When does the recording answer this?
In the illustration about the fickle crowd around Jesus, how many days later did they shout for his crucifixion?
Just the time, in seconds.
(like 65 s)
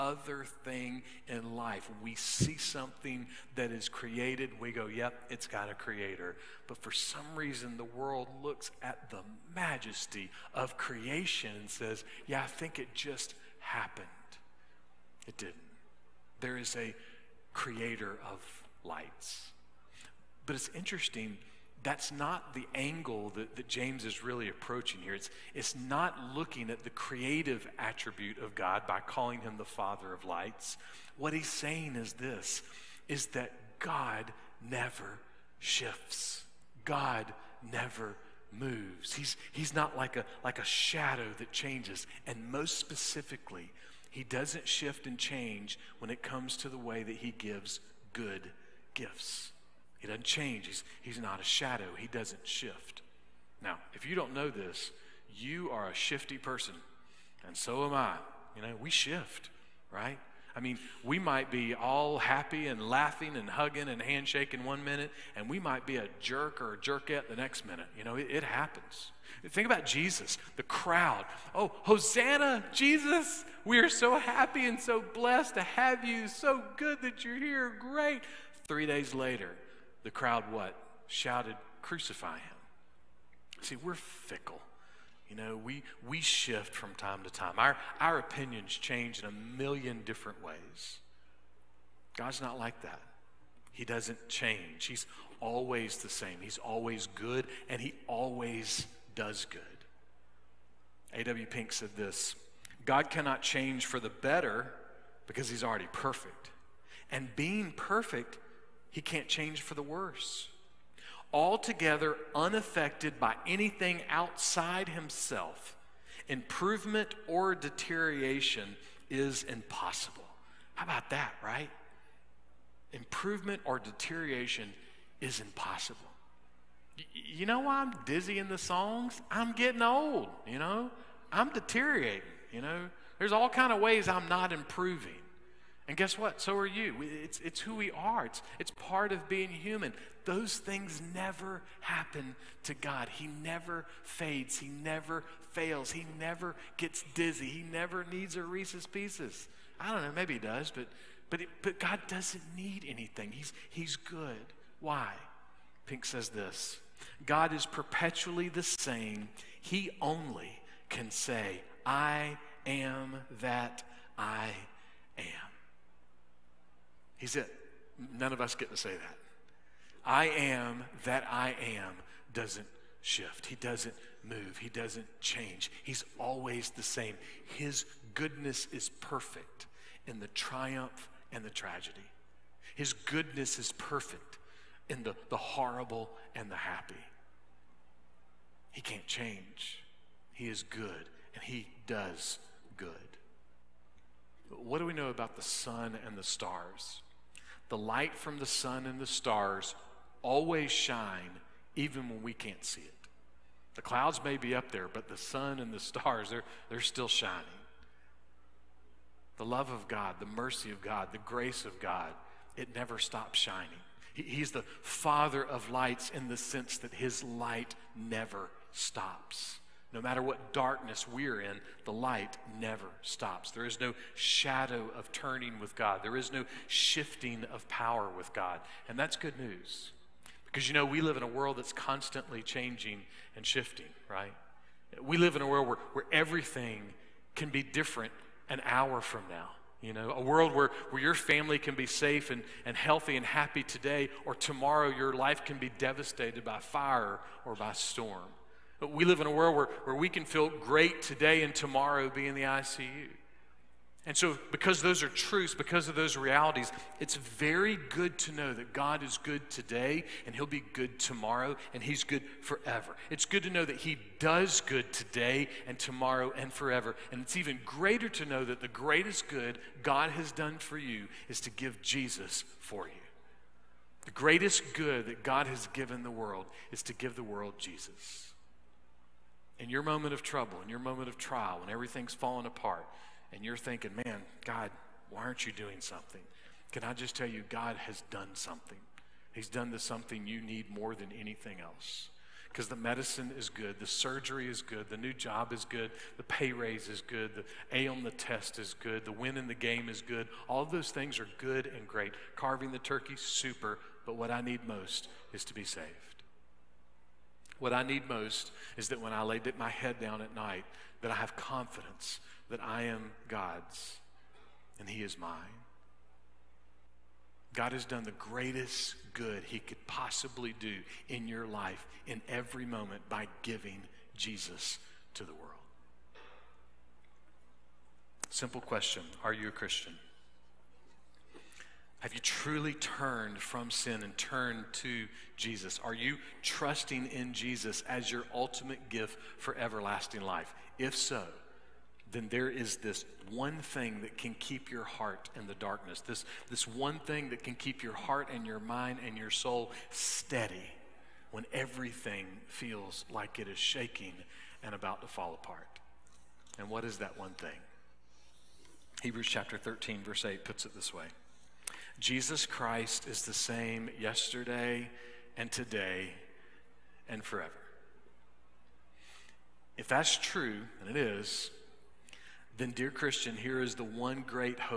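78 s.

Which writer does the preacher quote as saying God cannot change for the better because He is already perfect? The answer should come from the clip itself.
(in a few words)
A.W. Pink.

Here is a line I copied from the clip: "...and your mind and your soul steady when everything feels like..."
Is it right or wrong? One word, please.
right.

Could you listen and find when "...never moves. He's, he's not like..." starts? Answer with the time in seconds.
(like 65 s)
37 s.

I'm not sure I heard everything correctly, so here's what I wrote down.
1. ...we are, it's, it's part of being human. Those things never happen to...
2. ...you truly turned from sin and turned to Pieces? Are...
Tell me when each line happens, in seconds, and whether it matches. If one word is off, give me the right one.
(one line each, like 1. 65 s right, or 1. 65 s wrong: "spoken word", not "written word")
1. 137 s right
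2. 332 s wrong: "Jesus", not "Pieces".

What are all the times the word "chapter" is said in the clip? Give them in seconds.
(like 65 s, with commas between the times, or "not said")
359 s.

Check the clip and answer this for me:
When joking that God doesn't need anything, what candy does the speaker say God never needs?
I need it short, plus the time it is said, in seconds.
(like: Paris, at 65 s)
Reese's Pieces, at 148 s.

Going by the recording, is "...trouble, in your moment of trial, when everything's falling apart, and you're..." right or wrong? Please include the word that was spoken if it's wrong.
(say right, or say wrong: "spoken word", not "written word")
right.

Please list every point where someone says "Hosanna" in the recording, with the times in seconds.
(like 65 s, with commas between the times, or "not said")
71 s.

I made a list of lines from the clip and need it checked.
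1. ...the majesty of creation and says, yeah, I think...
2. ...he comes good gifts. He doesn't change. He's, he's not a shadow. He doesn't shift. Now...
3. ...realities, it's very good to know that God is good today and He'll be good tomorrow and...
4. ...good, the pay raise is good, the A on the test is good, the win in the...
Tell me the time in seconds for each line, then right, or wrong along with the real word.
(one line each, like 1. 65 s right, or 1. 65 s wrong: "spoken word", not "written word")
1. 9 s right
2. 47 s wrong: "gives", not "comes"
3. 256 s right
4. 295 s right.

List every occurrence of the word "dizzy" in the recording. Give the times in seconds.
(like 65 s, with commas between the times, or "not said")
128 s, 147 s.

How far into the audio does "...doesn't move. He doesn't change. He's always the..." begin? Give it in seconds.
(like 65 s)
173 s.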